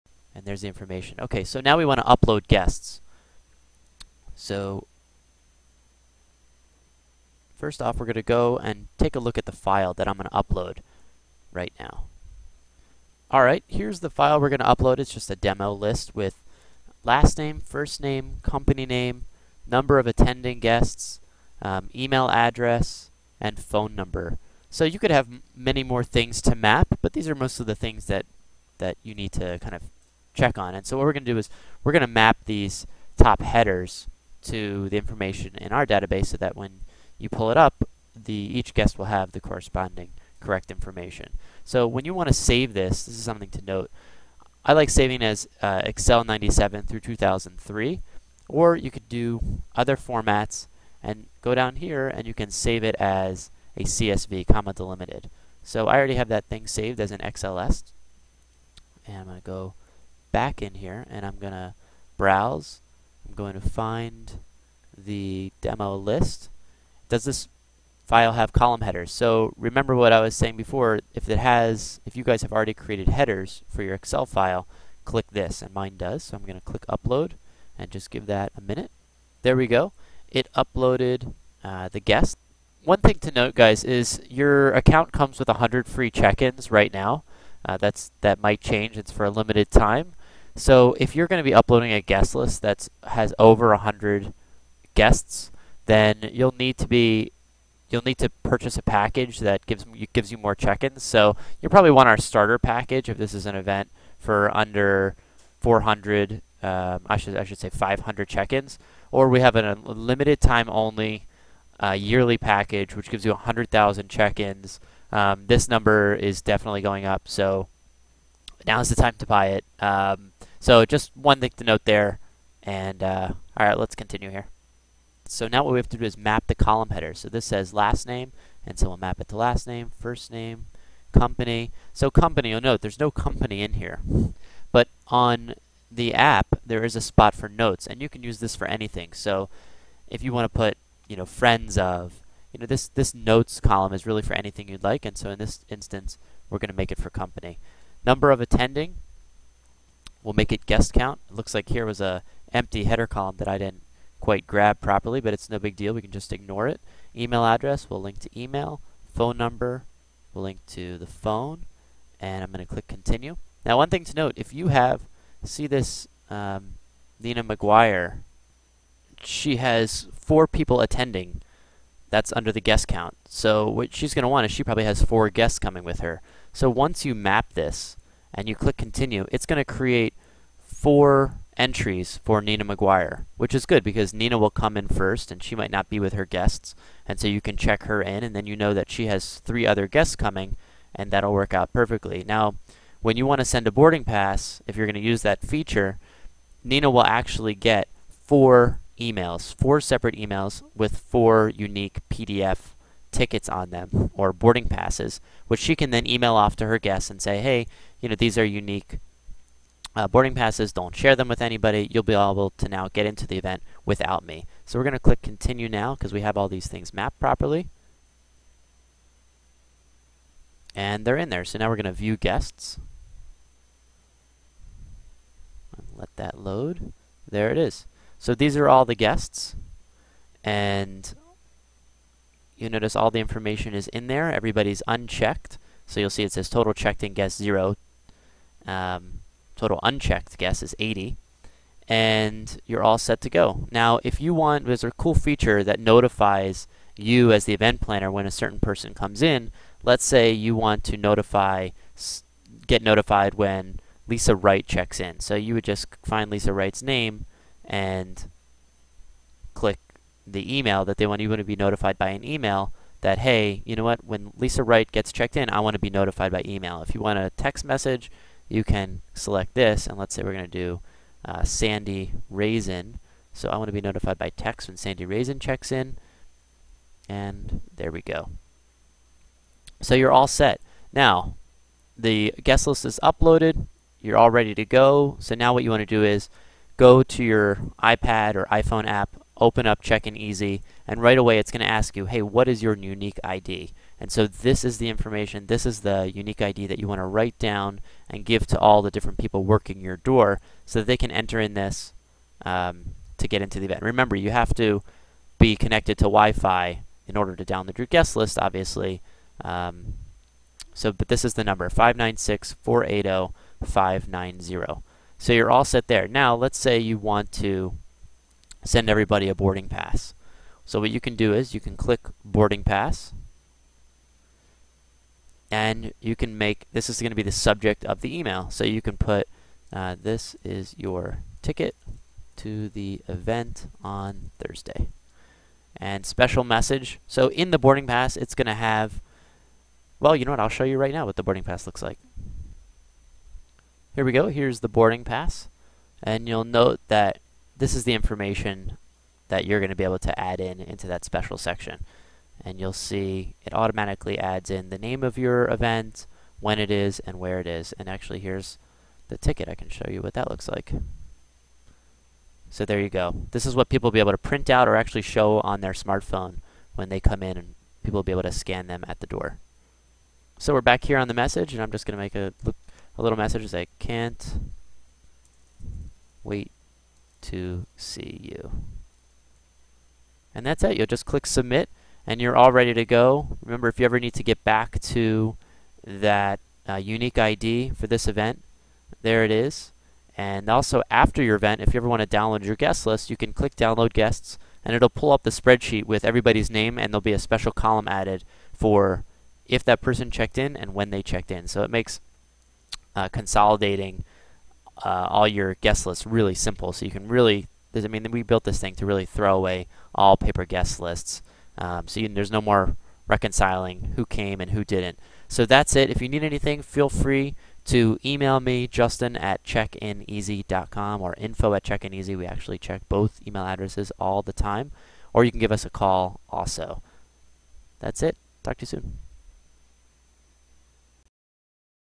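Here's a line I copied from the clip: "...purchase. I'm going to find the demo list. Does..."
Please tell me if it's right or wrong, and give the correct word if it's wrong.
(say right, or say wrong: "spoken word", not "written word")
wrong: "browse", not "purchase".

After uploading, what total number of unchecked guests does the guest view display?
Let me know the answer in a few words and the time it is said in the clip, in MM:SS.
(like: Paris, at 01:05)
80, at 04:00.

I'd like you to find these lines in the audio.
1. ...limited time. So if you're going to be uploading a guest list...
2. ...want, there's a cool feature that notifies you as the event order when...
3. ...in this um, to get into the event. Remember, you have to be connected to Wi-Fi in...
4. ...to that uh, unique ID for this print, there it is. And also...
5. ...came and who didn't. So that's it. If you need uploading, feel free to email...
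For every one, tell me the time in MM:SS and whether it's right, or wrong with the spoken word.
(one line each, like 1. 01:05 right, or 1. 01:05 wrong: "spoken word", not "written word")
1. 01:29 right
2. 04:04 wrong: "planner", not "order"
3. 05:01 right
4. 06:24 wrong: "event", not "print"
5. 06:54 wrong: "anything", not "uploading".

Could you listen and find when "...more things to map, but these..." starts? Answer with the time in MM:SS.
00:25.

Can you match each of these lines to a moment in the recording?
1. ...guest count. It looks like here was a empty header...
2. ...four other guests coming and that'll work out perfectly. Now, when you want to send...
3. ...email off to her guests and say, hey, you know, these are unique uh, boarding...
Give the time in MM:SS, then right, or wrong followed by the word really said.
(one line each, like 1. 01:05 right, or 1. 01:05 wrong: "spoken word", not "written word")
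1. 02:30 right
2. 03:09 wrong: "three", not "four"
3. 03:26 right.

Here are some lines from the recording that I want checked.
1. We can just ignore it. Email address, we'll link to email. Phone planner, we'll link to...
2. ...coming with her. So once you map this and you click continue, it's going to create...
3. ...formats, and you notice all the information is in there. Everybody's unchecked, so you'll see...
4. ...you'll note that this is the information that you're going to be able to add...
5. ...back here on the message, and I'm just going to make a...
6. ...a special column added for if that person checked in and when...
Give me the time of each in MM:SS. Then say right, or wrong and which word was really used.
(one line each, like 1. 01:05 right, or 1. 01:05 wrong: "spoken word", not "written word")
1. 02:35 wrong: "number", not "planner"
2. 02:55 right
3. 03:48 wrong: "guests", not "formats"
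4. 05:46 right
5. 06:10 right
6. 06:37 right.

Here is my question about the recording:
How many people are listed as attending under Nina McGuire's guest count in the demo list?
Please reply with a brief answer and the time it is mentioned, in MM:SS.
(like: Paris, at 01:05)
4, at 02:50.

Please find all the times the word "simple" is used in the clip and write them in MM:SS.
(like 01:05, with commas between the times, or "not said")
06:46.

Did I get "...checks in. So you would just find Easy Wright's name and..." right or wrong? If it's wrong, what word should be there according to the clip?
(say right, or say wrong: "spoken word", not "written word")
wrong: "Lisa", not "Easy".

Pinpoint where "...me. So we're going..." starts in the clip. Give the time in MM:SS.
03:34.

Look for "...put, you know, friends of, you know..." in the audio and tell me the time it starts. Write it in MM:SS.
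02:20.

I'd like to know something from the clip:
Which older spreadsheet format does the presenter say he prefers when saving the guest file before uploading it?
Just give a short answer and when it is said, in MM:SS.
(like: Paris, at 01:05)
Excel 97 through 2003, at 00:45.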